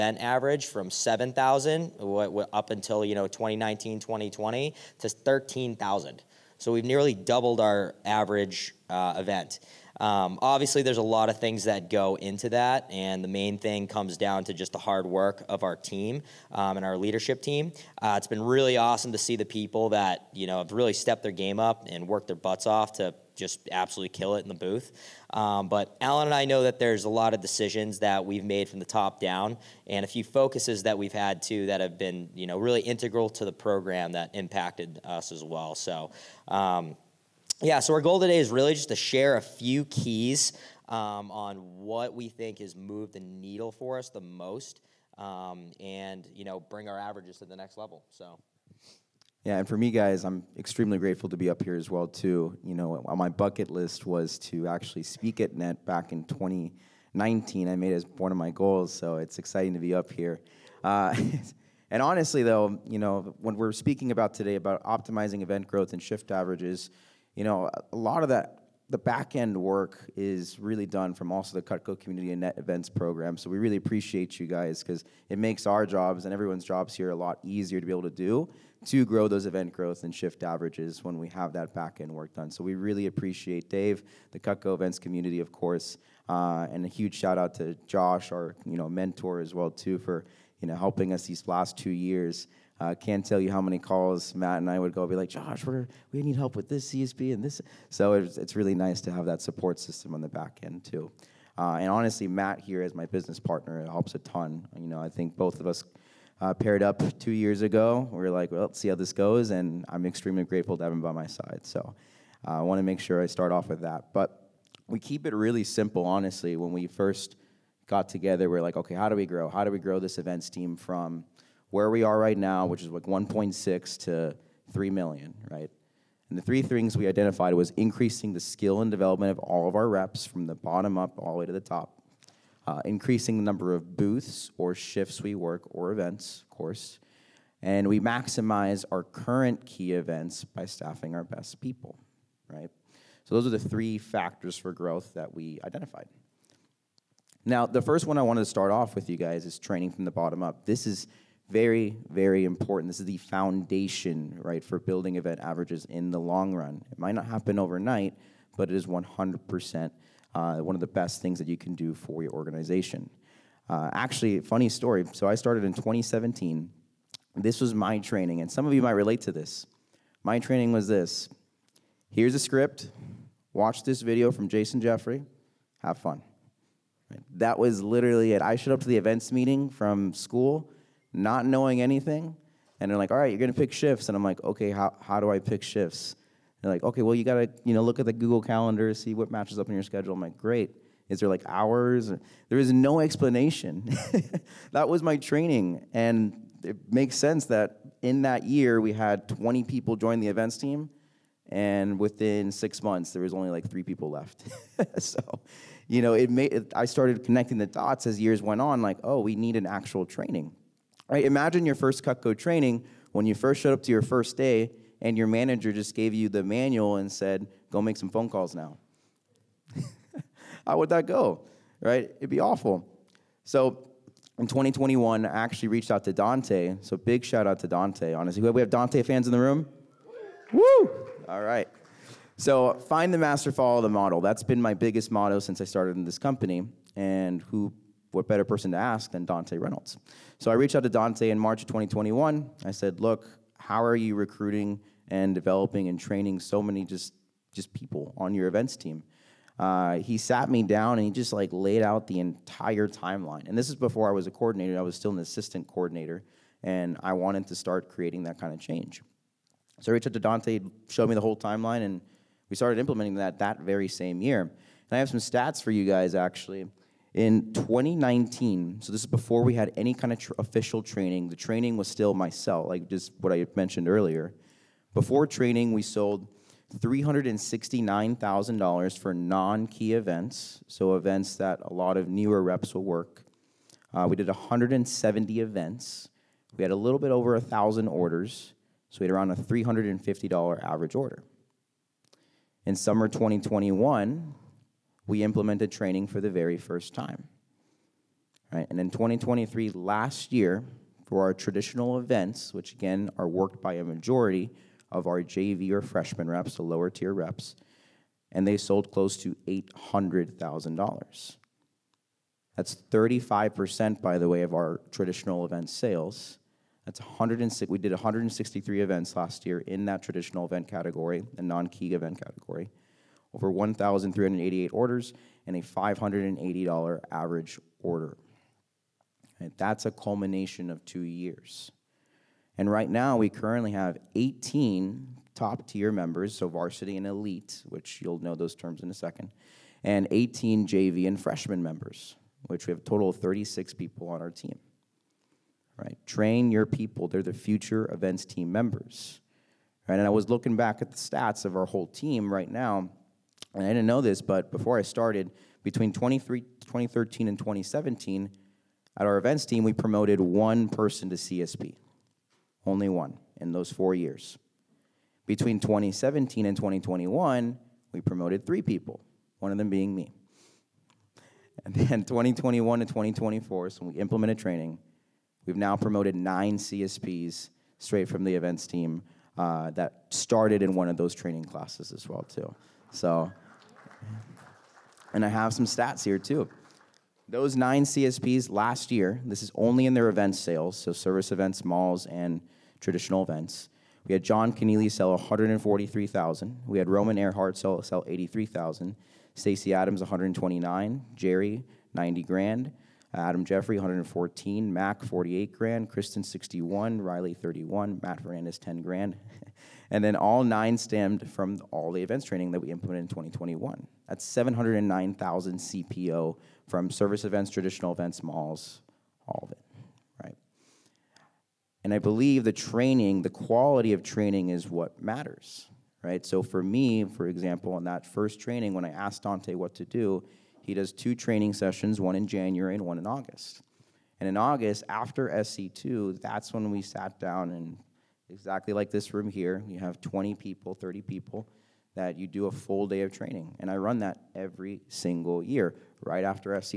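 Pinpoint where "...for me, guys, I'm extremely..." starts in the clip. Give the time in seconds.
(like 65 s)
49 s.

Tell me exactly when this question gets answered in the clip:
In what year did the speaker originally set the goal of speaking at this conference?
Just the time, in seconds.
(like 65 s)
55 s.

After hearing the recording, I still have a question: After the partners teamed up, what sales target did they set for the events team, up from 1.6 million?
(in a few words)
3 million.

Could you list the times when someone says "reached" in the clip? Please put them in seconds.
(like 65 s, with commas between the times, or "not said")
225 s, 240 s, 259 s.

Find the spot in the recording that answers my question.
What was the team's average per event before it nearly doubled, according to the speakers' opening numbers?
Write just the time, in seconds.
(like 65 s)
0 s.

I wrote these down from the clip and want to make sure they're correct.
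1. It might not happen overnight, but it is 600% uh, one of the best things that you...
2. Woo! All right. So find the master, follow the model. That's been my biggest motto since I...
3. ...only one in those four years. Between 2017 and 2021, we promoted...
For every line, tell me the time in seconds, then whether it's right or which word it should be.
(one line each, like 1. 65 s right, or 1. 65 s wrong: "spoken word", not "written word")
1. 156 s wrong: "100", not "600"
2. 230 s right
3. 362 s right.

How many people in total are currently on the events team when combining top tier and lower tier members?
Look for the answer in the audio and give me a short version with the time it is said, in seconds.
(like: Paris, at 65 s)
36, at 343 s.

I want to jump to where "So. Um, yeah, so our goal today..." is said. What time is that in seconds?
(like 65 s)
35 s.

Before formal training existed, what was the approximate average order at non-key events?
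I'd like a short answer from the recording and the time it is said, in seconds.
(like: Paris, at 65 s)
$350, at 289 s.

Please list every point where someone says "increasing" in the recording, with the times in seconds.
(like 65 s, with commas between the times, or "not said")
127 s, 132 s.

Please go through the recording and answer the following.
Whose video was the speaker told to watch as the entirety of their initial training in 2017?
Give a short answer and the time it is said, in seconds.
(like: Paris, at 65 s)
Jason Jeffrey, at 174 s.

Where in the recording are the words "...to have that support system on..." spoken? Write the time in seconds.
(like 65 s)
99 s.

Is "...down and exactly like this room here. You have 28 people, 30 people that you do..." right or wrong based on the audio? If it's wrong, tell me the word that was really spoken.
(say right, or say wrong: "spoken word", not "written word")
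wrong: "20", not "28".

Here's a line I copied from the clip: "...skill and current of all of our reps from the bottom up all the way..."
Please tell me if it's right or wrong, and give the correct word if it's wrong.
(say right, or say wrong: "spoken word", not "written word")
wrong: "development", not "current".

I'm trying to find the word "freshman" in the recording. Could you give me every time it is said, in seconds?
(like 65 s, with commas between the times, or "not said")
305 s, 341 s.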